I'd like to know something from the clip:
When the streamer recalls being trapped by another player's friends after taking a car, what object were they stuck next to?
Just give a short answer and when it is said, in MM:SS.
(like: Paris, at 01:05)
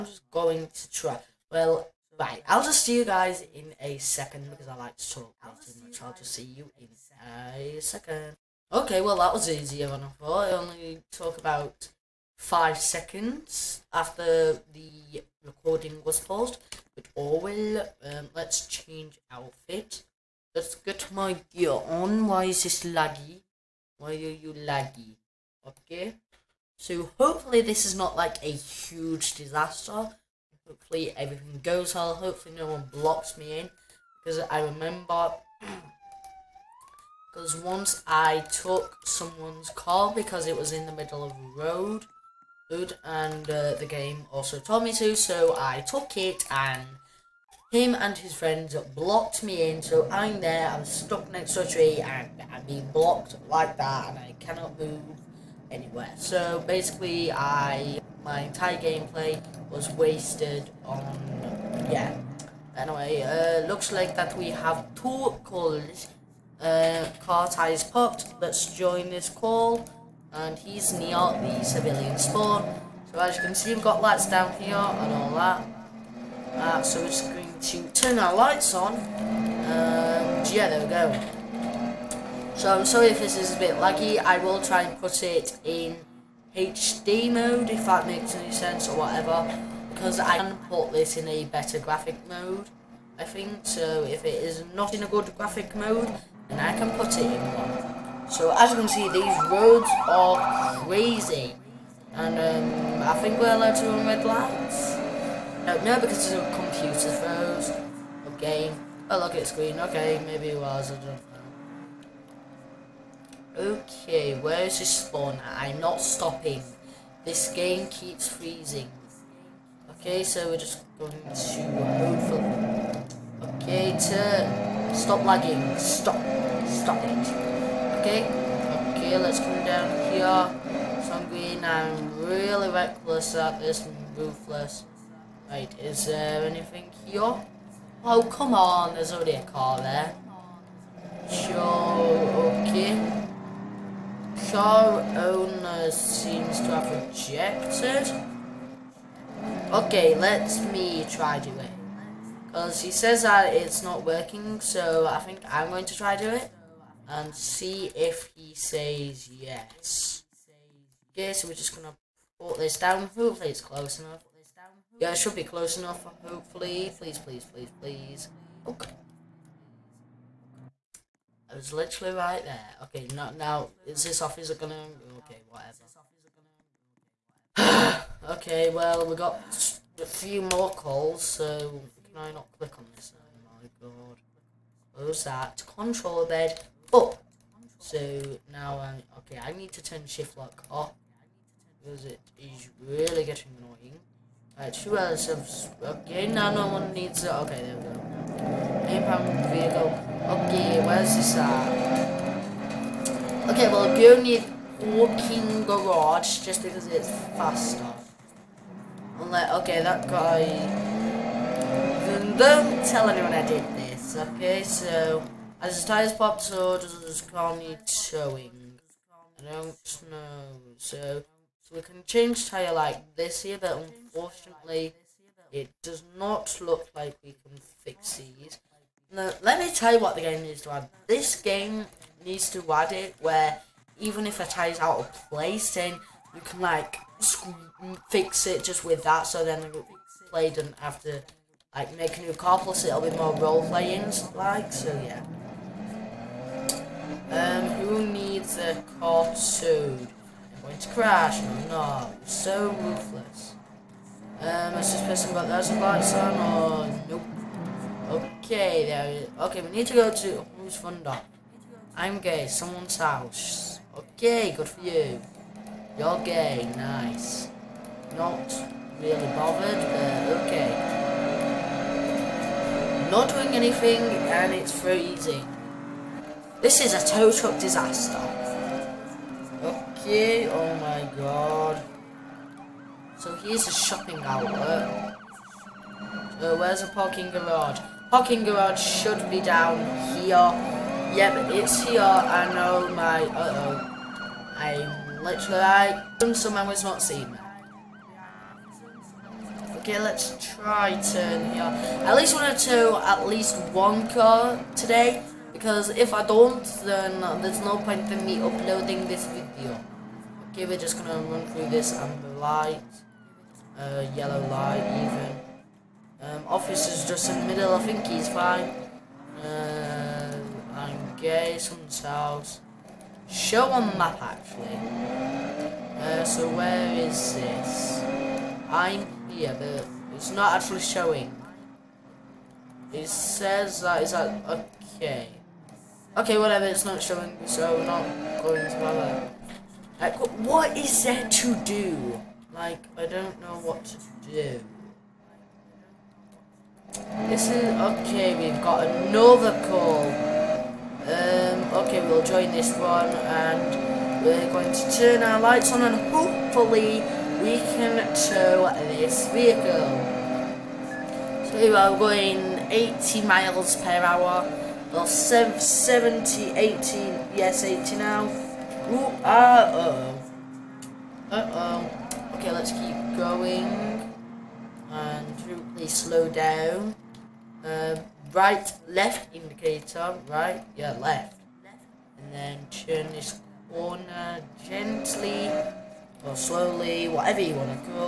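A tree, at 00:51.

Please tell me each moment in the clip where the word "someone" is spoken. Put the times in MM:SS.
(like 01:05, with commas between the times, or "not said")
00:39, 04:22, 04:56, 05:21.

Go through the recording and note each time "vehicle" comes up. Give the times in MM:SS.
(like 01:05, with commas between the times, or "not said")
03:19, 05:59.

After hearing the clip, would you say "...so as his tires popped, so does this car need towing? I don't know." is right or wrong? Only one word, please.
right.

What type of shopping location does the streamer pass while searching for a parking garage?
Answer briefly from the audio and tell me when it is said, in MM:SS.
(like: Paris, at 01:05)
A shopping outlet, at 04:43.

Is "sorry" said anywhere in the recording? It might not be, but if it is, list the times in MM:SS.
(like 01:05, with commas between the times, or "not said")
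01:22.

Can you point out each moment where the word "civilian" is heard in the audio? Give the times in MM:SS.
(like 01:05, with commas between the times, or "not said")
01:11.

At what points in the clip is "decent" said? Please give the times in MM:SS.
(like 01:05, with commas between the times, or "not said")
not said.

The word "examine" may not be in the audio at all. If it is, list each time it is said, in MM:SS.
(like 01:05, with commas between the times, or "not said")
not said.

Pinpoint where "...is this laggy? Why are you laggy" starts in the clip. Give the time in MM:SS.
00:22.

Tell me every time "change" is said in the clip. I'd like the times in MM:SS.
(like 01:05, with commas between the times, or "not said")
00:18, 03:42.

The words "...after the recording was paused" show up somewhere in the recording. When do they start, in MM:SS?
00:13.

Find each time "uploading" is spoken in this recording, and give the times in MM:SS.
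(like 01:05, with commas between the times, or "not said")
05:08.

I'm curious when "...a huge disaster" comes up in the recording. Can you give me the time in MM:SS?
00:28.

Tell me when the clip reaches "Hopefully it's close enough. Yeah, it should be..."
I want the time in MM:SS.
02:43.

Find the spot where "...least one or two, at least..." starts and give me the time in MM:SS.
05:02.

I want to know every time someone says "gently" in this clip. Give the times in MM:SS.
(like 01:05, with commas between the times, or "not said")
06:24.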